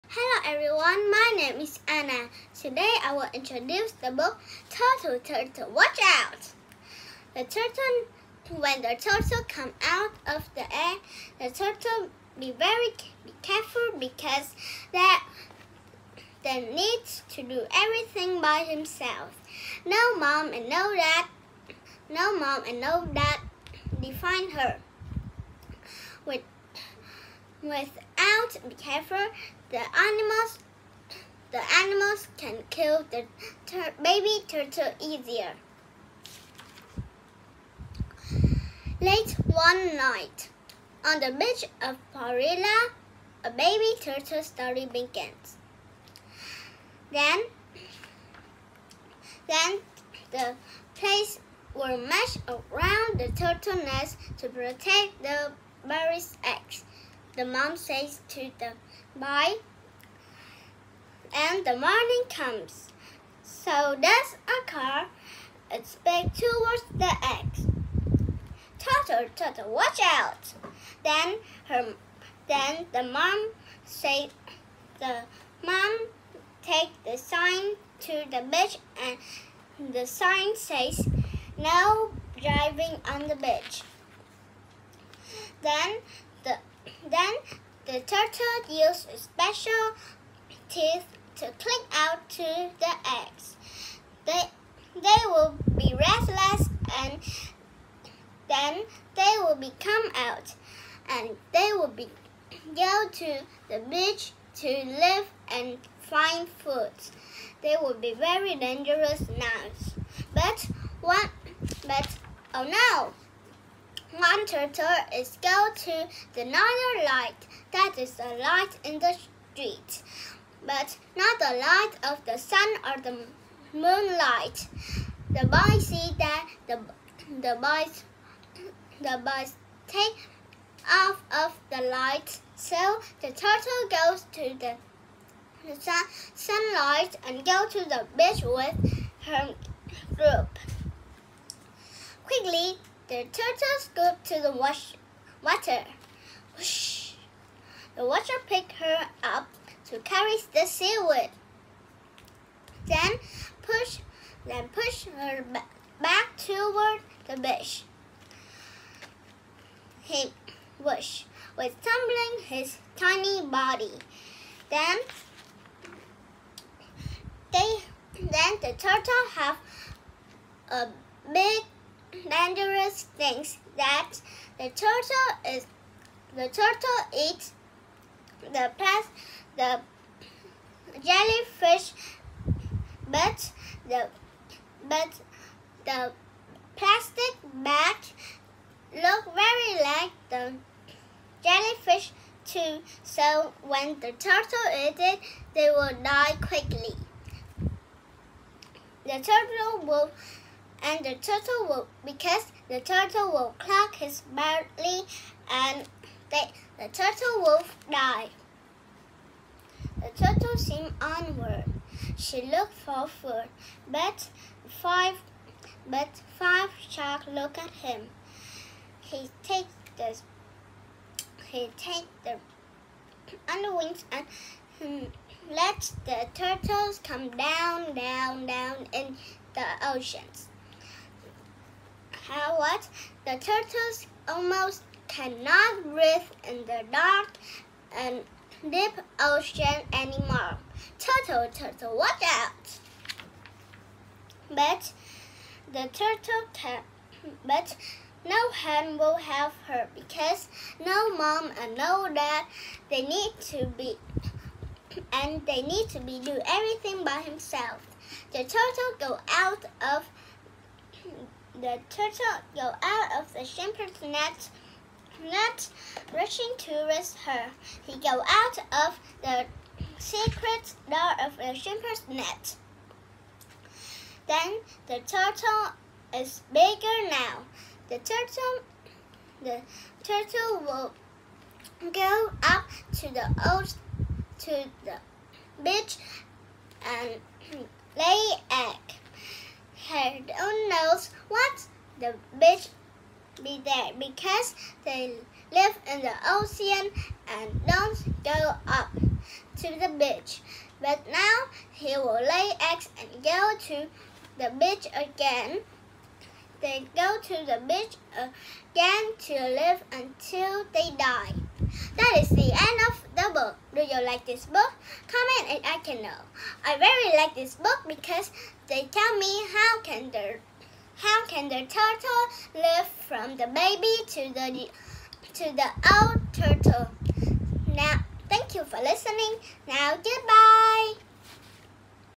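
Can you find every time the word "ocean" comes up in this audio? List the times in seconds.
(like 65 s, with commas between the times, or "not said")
229 s, 239 s, 296 s.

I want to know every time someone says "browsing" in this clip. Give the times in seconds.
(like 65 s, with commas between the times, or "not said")
not said.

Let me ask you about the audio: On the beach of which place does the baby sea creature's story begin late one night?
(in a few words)
Parilla.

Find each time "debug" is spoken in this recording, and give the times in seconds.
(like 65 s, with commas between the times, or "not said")
not said.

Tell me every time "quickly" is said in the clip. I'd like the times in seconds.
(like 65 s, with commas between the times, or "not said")
142 s, 196 s.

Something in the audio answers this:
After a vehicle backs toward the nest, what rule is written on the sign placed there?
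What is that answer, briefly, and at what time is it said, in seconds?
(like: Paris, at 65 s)
No driving on the beach, at 81 s.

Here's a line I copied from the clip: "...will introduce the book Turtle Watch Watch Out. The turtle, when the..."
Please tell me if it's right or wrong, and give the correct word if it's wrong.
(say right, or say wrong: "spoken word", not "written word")
wrong: "Turtle", not "Watch".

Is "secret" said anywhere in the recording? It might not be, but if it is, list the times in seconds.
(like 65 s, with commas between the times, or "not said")
269 s.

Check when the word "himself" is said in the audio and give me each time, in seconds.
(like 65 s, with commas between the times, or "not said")
18 s, 257 s.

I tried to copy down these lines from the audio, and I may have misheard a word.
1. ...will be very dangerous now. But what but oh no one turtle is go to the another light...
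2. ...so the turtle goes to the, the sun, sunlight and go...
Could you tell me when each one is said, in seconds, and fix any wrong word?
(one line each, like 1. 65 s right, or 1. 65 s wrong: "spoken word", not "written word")
1. 107 s right
2. 132 s right.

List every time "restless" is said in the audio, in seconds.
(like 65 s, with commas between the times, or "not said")
95 s.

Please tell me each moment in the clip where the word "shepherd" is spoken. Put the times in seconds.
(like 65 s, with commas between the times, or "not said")
263 s, 271 s.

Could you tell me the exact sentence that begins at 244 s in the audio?
But the turtle can, but no hand will help her because no mom and no dad.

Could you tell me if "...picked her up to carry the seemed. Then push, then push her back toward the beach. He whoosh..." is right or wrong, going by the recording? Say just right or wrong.
wrong.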